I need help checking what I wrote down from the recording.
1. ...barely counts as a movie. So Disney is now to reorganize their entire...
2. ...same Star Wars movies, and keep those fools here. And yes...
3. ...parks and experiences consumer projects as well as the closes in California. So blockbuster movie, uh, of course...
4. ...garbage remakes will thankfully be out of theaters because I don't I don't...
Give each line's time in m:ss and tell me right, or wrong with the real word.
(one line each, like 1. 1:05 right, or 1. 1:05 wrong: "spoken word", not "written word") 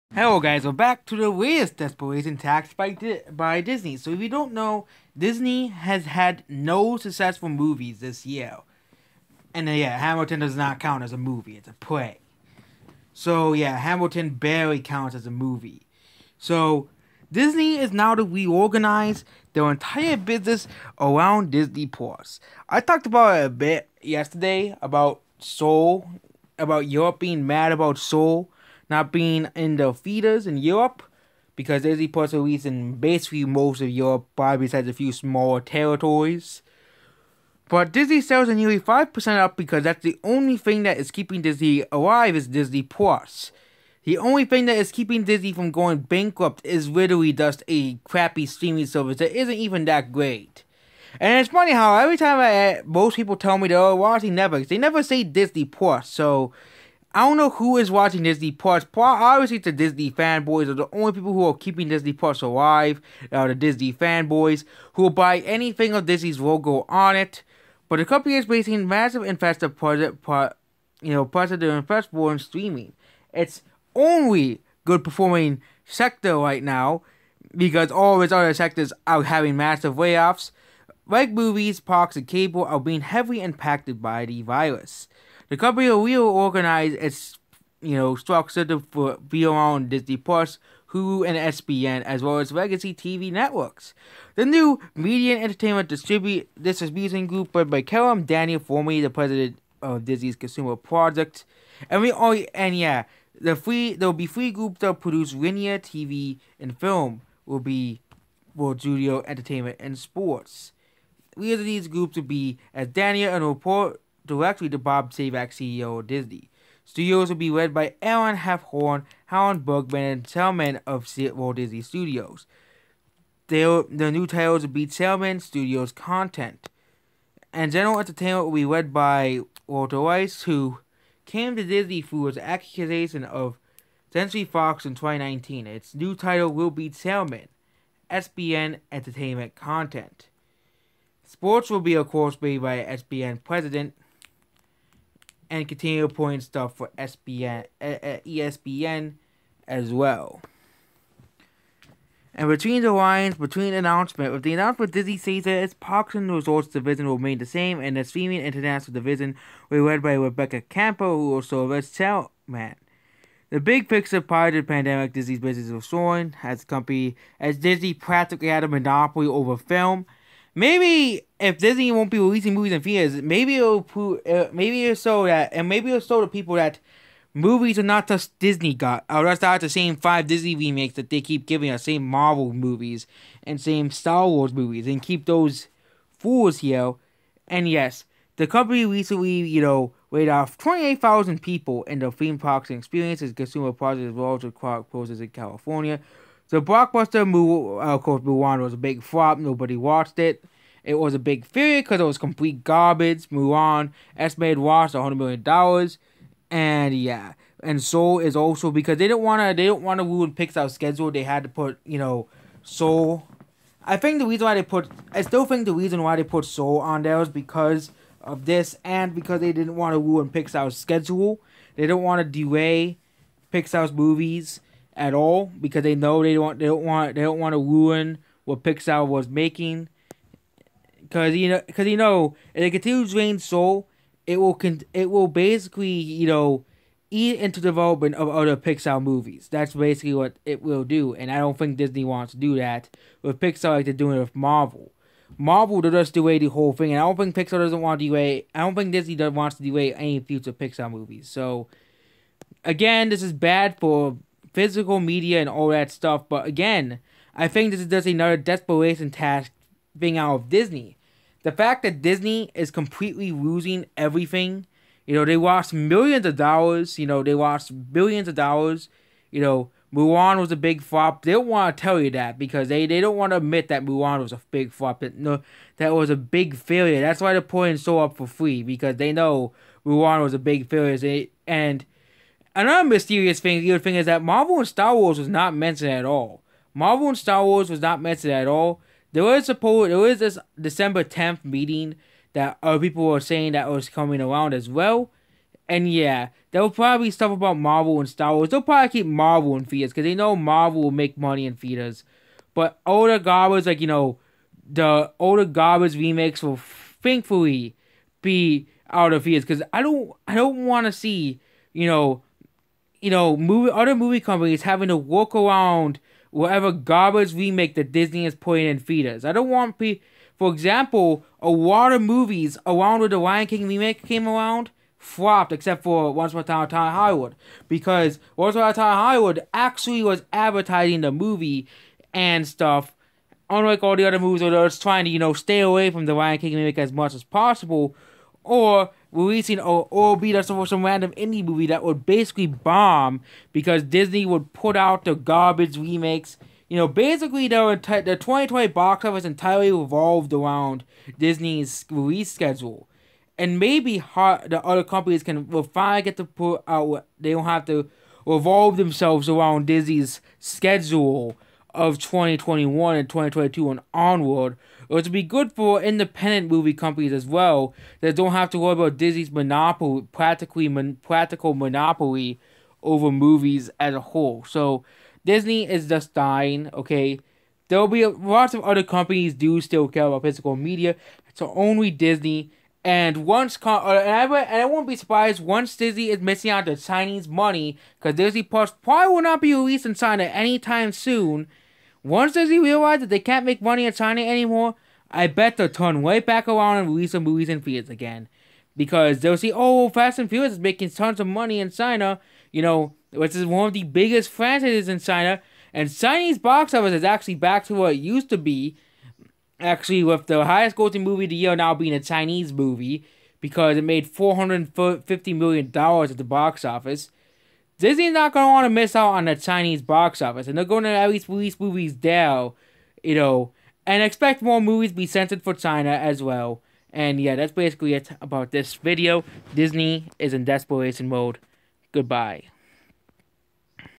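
1. 0:14 right
2. 3:03 right
3. 3:12 right
4. 5:05 right.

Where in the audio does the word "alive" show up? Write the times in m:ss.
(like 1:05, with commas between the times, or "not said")
0:41, 1:02.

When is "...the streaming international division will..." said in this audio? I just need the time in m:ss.
2:37.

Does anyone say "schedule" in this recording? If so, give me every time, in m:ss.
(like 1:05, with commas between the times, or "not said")
3:30, 3:40, 5:52, 6:00.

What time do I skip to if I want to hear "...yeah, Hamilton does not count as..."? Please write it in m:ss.
0:09.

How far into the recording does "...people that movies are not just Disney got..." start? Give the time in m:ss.
2:56.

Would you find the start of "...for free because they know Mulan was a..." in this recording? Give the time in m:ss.
4:38.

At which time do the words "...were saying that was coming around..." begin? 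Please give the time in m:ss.
4:53.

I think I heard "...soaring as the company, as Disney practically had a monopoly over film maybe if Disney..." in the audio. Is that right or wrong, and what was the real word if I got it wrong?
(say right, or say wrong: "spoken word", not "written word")
right.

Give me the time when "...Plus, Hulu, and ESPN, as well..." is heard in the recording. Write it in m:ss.
1:30.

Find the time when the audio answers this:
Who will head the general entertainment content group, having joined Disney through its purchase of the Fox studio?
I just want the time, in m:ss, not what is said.
2:09.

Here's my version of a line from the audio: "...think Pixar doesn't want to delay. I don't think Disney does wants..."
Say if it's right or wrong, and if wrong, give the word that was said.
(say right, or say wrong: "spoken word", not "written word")
right.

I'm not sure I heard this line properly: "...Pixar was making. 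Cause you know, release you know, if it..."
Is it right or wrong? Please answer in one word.
wrong.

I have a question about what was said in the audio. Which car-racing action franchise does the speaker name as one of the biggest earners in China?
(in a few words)
Fast and Furious.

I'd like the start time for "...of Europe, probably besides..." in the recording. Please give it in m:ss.
0:33.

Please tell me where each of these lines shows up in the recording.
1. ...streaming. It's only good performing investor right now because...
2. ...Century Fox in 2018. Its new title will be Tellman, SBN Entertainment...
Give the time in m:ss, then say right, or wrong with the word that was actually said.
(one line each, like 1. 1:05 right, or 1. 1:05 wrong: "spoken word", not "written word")
1. 1:12 wrong: "sector", not "investor"
2. 2:14 wrong: "2019", not "2018".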